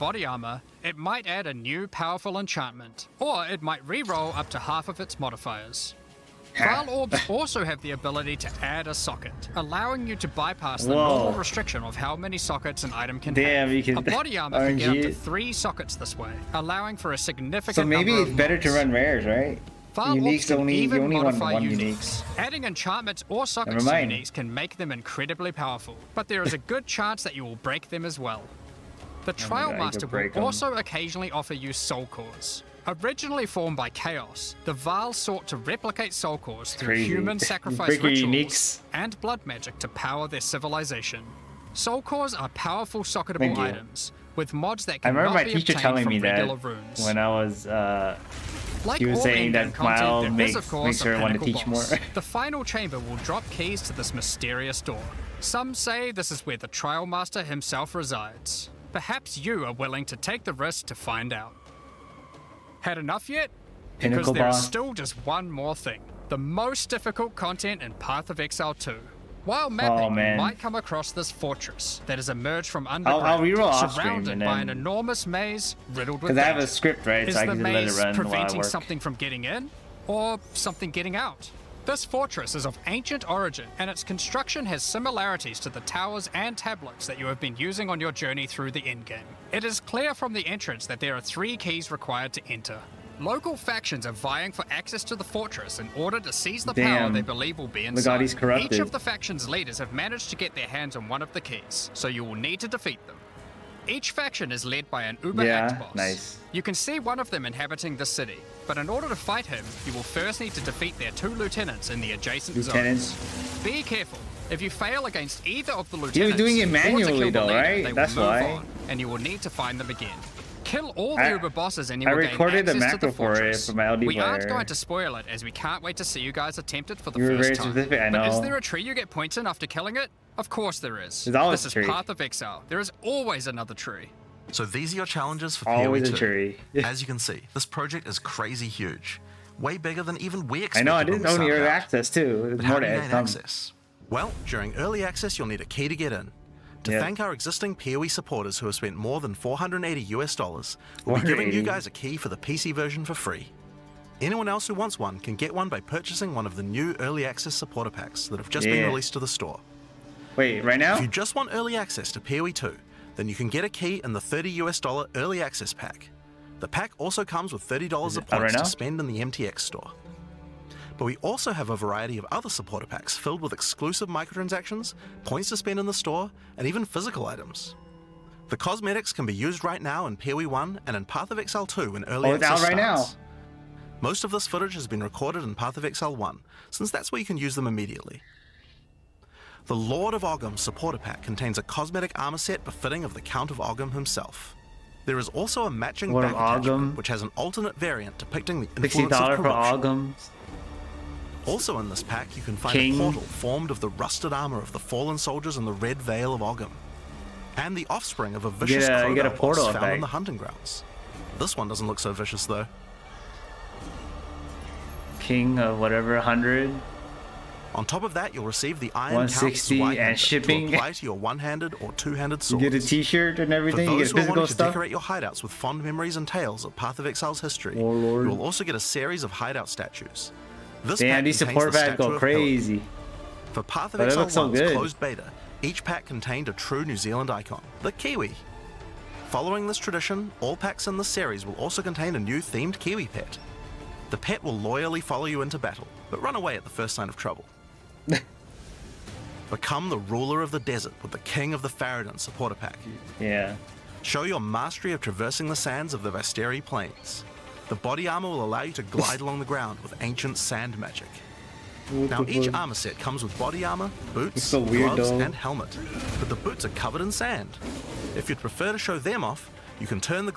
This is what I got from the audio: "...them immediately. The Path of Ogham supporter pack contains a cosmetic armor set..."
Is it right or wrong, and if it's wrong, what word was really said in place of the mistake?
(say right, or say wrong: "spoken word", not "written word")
wrong: "Lord", not "Path".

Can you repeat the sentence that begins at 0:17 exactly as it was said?
So maybe it's better to run rares, right?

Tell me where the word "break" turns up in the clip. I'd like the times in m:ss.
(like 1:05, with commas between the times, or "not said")
0:27.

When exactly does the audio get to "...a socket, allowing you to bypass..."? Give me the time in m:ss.
0:08.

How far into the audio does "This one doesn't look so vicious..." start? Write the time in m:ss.
3:31.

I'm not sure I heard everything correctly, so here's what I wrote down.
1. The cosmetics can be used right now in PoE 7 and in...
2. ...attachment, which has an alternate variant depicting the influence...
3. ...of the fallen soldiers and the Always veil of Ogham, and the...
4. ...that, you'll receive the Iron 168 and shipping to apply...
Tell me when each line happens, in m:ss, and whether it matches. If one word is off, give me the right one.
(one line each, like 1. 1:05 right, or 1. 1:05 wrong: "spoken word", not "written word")
1. 2:58 wrong: "1", not "7"
2. 3:16 right
3. 3:24 wrong: "Red", not "Always"
4. 3:38 wrong: "160", not "168".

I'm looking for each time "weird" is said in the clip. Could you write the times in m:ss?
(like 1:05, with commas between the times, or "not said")
4:24.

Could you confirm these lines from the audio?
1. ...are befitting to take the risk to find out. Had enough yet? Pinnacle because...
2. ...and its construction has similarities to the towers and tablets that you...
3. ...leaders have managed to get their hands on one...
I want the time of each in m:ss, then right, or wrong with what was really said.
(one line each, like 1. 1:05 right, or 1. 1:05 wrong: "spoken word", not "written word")
1. 0:59 wrong: "willing", not "befitting"
2. 1:23 right
3. 1:39 right.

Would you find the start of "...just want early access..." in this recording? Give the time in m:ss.
2:41.